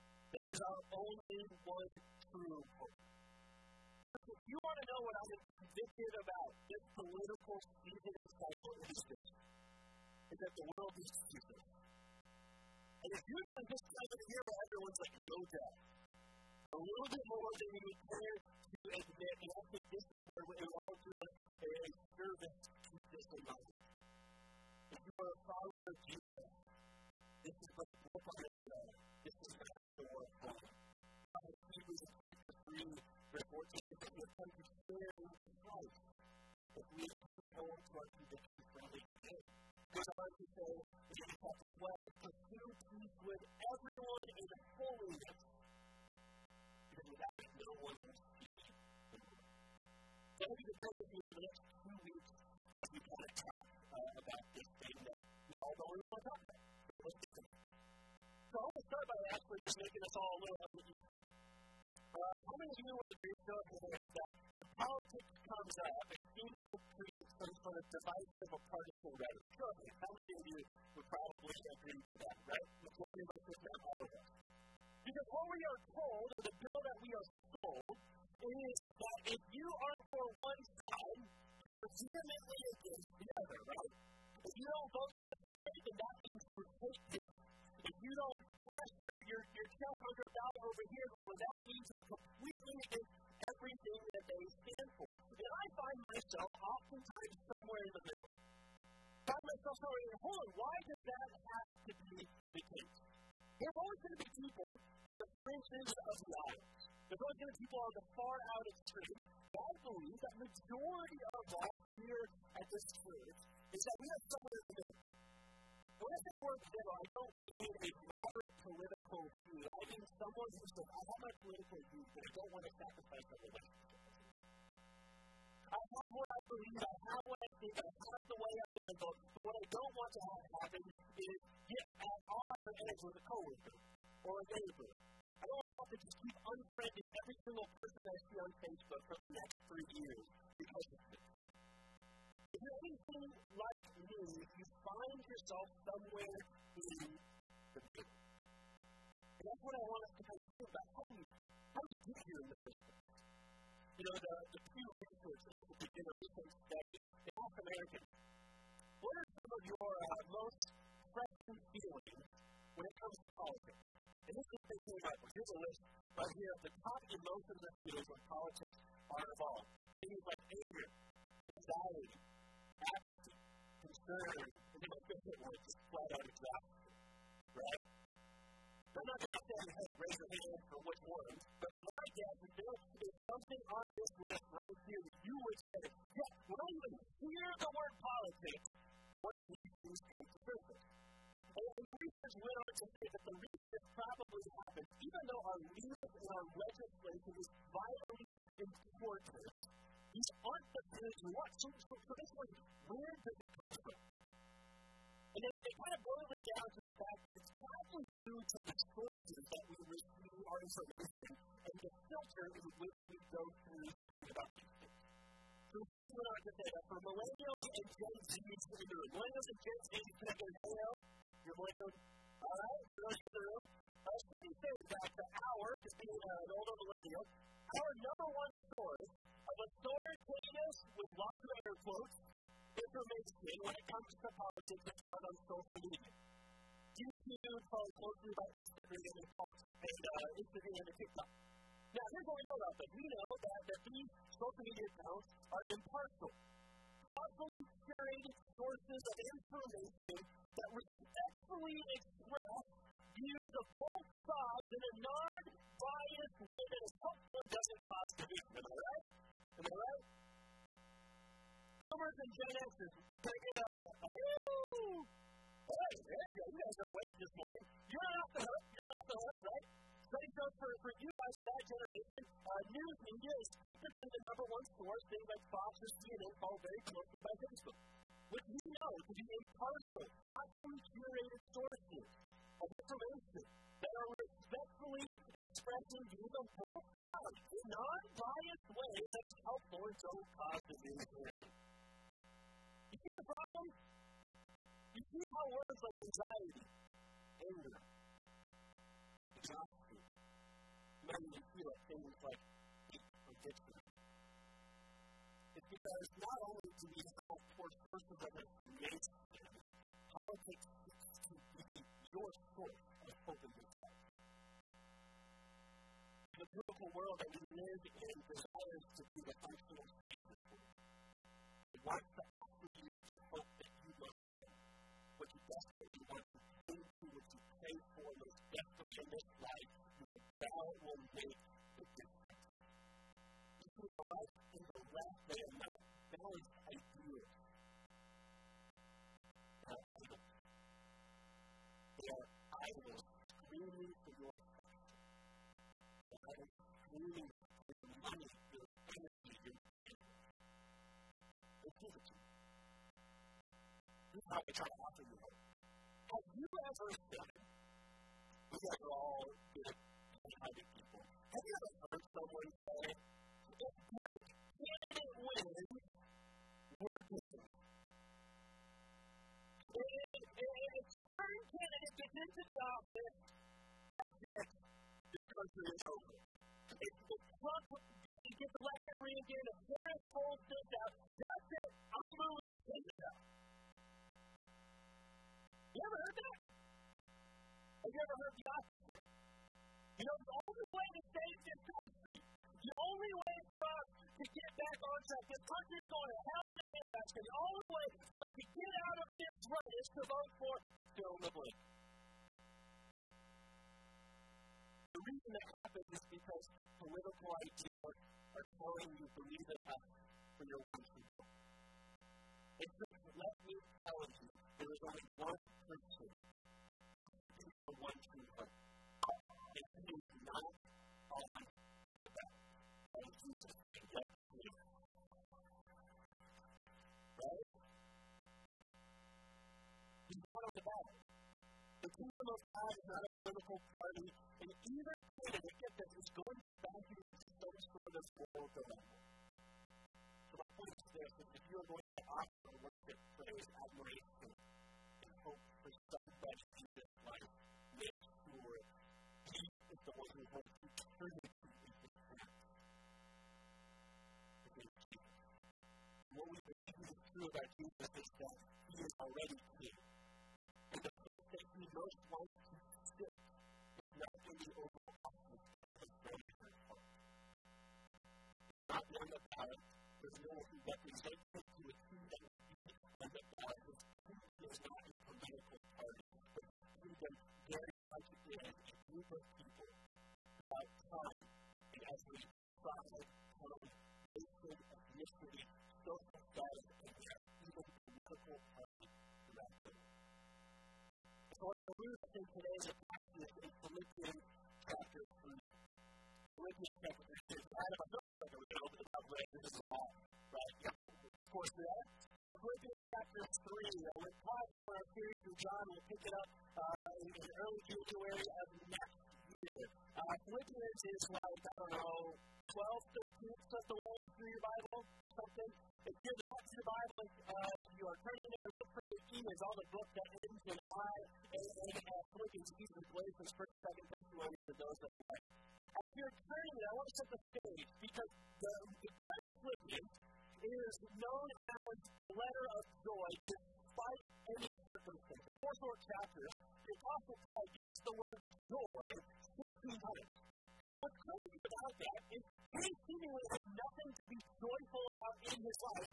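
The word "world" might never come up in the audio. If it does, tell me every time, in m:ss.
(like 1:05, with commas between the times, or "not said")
0:10, 5:16.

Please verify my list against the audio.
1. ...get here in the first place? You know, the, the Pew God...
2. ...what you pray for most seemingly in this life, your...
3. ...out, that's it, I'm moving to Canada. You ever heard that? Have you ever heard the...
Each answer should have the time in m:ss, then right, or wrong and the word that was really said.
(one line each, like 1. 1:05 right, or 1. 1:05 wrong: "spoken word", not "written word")
1. 2:32 wrong: "Research", not "God"
2. 5:27 wrong: "desperately", not "seemingly"
3. 6:20 right.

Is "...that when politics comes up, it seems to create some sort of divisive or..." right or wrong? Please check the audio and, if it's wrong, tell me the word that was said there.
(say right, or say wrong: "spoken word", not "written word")
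right.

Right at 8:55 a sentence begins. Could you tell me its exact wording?
The four short chapters, the Apostle Paul uses the word joy 16 times.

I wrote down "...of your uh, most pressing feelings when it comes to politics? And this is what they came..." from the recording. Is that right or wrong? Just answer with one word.
right.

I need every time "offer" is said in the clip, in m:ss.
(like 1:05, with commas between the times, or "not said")
5:22, 5:54, 7:22.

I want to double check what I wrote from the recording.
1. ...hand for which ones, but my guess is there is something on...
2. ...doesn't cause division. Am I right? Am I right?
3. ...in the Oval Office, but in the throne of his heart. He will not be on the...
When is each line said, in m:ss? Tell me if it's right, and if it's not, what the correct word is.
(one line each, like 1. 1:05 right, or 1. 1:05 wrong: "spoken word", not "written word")
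1. 3:00 right
2. 4:17 right
3. 7:44 right.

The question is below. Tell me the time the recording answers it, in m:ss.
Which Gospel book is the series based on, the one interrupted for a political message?
8:25.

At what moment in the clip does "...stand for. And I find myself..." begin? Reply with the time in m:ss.
1:34.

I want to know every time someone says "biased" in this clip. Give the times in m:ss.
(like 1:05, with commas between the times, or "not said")
4:15, 4:47.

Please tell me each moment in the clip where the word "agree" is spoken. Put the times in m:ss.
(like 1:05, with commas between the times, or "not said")
1:03, 1:11.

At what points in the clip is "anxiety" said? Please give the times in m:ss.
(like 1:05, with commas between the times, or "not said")
2:51, 4:56.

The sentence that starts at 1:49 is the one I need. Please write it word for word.
But I believe that majority of us here at this church is that we are somewhere in the middle.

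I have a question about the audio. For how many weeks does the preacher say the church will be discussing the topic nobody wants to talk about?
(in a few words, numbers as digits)
2.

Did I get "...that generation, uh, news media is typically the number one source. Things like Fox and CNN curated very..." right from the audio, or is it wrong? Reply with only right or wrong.
wrong.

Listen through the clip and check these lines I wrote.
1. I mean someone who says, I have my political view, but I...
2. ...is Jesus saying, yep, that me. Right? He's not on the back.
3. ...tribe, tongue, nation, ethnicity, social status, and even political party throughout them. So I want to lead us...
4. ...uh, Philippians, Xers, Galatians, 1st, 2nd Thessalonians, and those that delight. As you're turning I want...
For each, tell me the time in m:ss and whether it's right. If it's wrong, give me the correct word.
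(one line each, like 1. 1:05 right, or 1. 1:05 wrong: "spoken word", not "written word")
1. 1:59 right
2. 7:03 right
3. 8:02 right
4. 8:41 wrong: "Ephesians", not "Xers".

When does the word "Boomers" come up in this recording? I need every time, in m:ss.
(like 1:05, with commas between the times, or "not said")
4:21.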